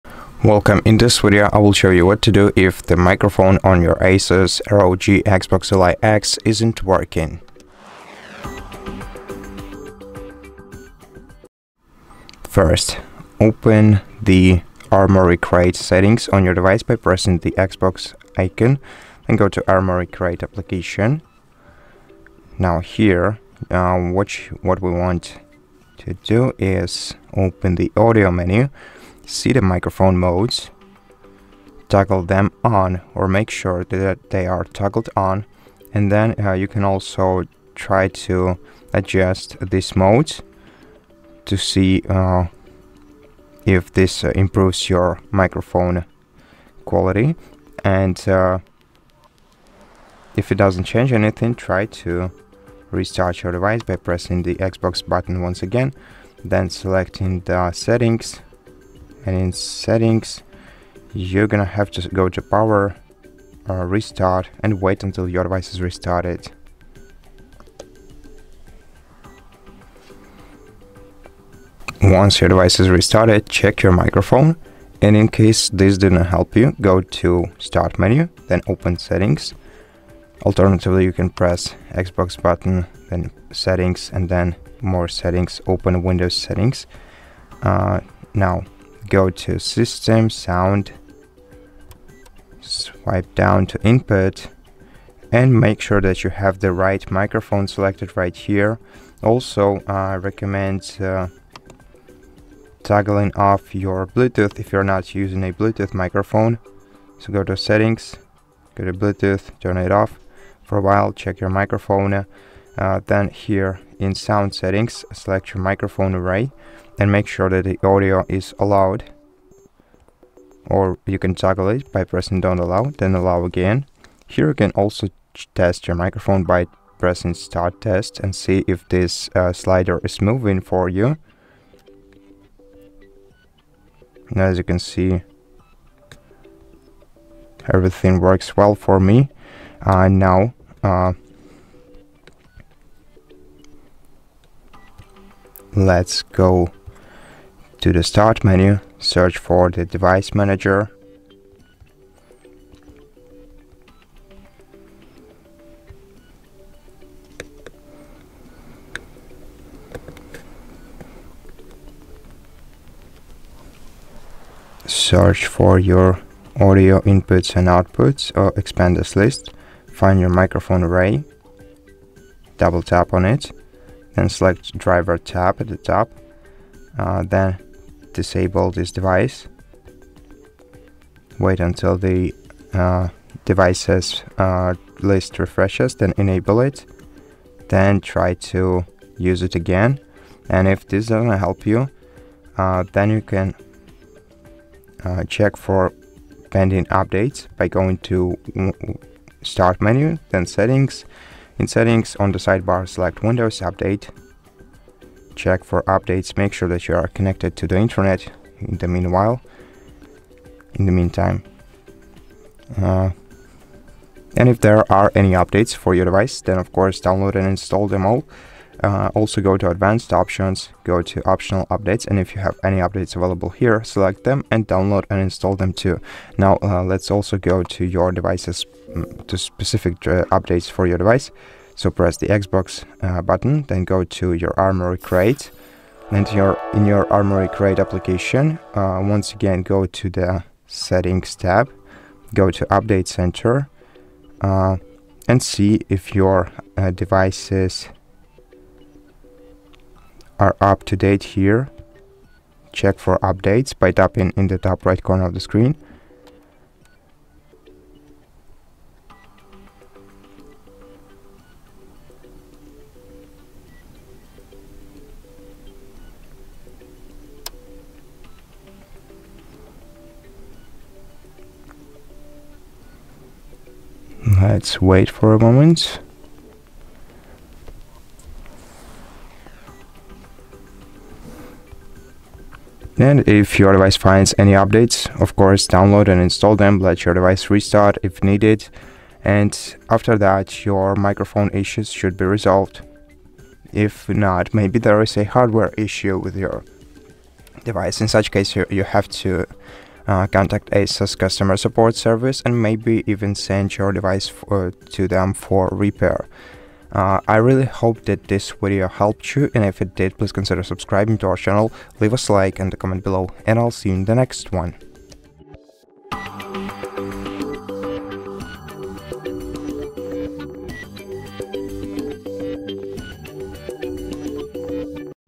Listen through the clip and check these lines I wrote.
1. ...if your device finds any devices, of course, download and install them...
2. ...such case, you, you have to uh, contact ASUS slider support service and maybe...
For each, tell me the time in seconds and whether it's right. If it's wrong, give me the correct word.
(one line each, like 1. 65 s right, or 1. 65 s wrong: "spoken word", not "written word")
1. 283 s wrong: "updates", not "devices"
2. 298 s wrong: "customer", not "slider".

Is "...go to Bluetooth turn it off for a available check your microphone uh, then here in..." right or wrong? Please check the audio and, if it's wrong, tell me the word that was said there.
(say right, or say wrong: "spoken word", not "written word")
wrong: "while", not "available".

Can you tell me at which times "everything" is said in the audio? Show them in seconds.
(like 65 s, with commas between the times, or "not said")
137 s.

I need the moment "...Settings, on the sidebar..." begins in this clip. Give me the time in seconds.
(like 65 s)
201 s.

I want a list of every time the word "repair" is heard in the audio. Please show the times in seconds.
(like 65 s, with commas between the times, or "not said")
305 s.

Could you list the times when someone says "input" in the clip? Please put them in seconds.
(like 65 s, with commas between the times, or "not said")
93 s, 167 s.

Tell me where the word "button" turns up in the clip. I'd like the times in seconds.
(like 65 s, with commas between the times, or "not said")
55 s, 82 s, 233 s.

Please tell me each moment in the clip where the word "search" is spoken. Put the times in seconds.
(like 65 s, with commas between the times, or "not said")
148 s, 164 s.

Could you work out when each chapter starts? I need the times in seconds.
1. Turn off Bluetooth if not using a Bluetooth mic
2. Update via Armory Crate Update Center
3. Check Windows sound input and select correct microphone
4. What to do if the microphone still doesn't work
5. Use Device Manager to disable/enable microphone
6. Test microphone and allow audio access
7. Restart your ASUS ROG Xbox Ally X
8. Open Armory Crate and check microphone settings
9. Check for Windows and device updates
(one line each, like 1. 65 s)
1. 105 s
2. 250 s
3. 72 s
4. 292 s
5. 150 s
6. 120 s
7. 41 s
8. 12 s
9. 191 s.